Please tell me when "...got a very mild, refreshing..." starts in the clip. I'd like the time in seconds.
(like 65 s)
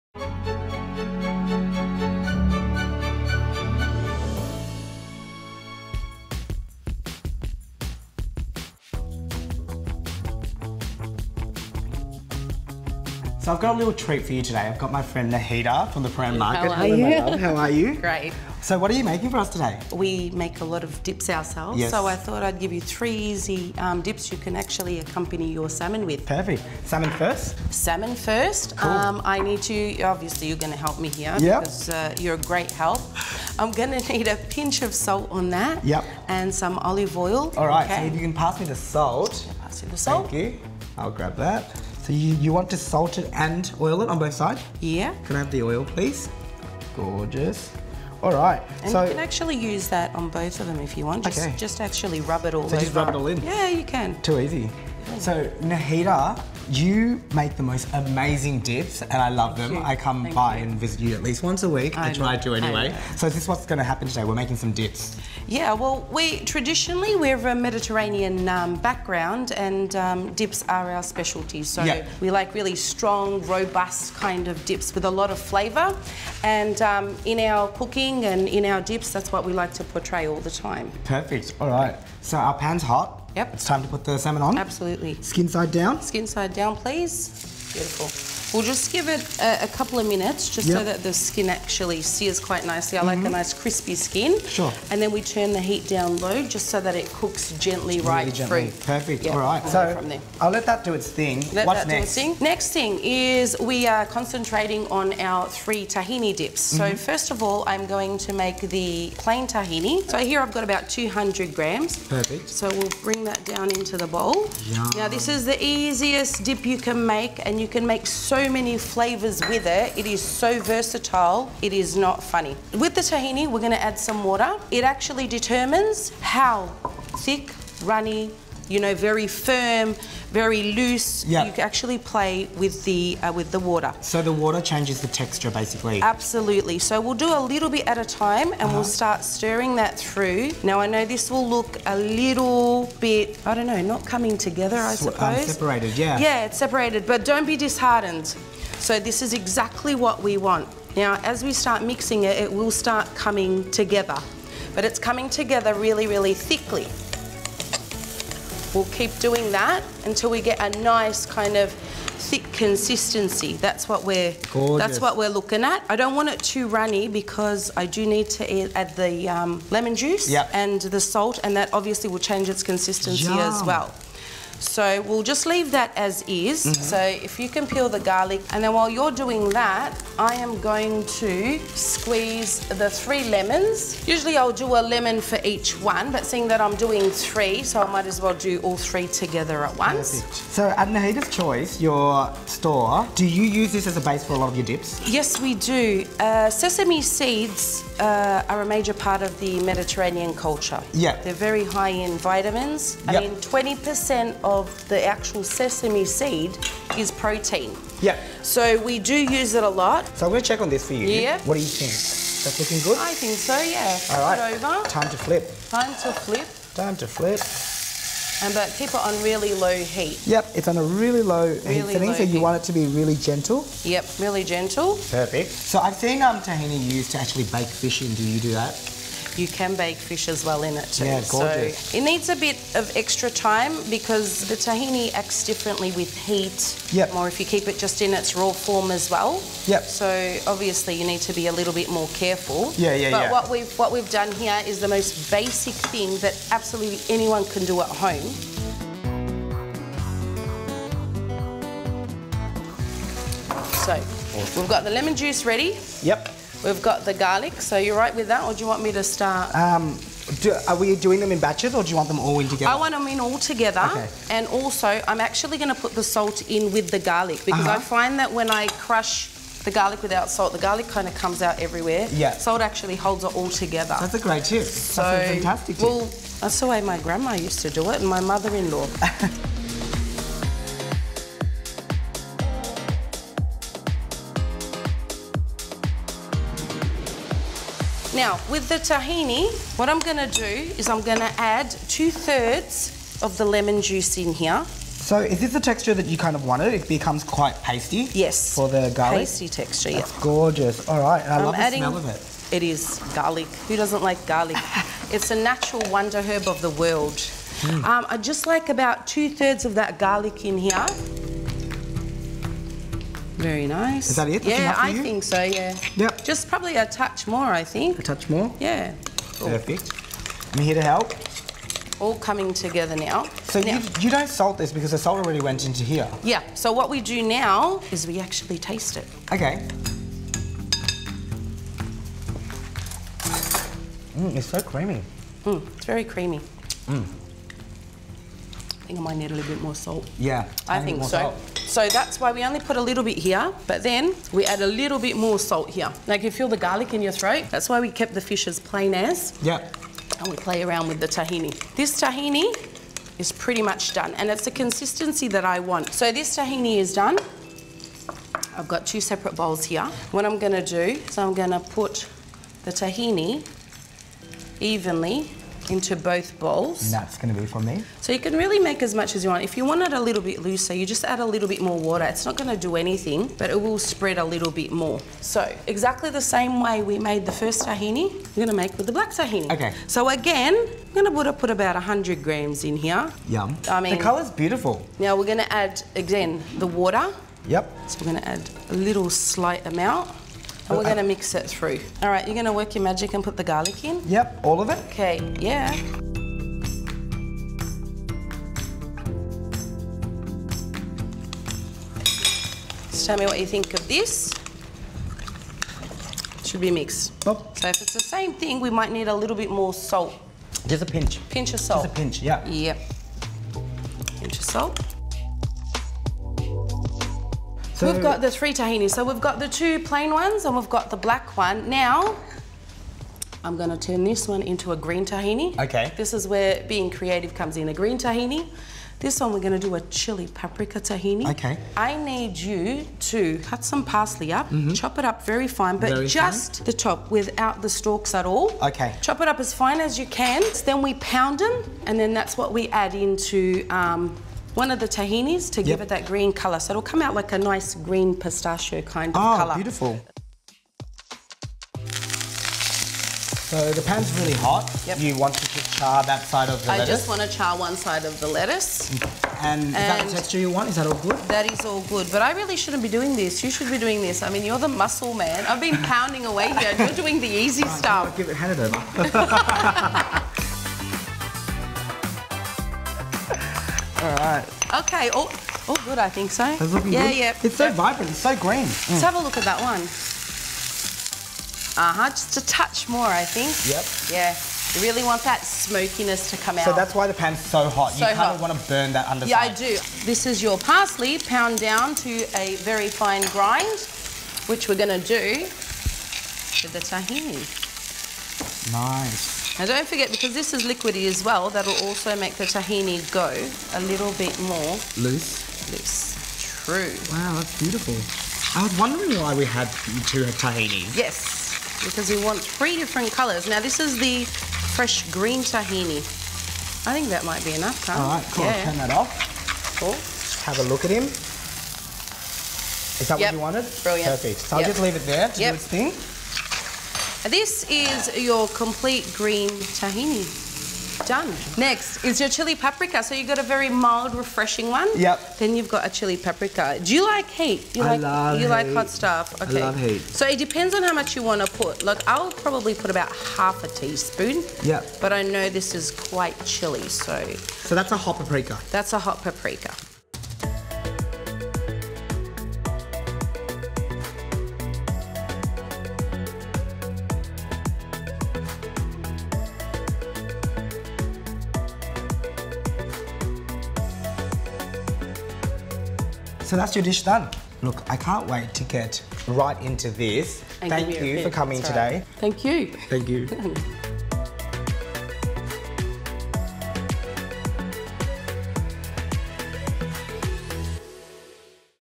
533 s.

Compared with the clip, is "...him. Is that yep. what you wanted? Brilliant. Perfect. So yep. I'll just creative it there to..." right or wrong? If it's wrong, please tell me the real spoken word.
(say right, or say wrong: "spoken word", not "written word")
wrong: "leave", not "creative".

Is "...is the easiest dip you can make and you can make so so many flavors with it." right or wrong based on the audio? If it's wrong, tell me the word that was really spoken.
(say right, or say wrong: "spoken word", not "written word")
right.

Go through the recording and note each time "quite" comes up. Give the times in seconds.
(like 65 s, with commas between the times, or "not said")
92 s, 297 s, 545 s.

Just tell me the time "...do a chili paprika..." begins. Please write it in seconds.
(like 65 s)
429 s.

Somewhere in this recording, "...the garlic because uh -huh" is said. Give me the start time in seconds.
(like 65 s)
266 s.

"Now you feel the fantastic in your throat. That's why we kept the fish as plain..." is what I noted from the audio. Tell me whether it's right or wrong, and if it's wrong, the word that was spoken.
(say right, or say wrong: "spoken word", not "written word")
wrong: "garlic", not "fantastic".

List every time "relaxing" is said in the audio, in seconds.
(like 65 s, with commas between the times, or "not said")
not said.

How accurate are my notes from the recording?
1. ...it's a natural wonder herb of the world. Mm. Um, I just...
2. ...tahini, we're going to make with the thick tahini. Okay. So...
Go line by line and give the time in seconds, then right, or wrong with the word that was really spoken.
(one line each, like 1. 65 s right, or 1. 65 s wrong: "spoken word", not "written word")
1. 305 s right
2. 377 s wrong: "black", not "thick".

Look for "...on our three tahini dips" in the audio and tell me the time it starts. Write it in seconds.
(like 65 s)
104 s.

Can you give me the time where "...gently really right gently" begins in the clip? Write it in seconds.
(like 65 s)
97 s.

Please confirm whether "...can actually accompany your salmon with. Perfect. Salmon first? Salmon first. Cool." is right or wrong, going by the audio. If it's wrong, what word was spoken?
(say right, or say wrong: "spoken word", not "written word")
right.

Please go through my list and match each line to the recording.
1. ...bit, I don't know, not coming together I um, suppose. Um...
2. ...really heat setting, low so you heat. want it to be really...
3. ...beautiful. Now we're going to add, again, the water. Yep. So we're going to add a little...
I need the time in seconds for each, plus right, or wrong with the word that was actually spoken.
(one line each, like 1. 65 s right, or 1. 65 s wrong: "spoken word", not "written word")
1. 143 s right
2. 221 s right
3. 384 s right.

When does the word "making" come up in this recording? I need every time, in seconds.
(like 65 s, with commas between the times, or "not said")
19 s, 64 s.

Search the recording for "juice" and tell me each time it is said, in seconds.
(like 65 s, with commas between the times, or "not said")
169 s, 255 s, 293 s.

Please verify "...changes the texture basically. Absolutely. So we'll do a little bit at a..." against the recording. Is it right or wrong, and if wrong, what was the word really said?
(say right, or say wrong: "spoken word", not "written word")
right.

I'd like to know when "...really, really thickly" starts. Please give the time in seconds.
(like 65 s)
155 s.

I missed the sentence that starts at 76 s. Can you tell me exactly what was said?
And um, in our cooking and in our dips, that's what we like to portray all the time.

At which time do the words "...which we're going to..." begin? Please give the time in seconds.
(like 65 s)
494 s.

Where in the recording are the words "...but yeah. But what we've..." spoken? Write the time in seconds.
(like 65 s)
243 s.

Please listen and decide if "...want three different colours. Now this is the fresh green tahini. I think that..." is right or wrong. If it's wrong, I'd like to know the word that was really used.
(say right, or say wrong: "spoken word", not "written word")
right.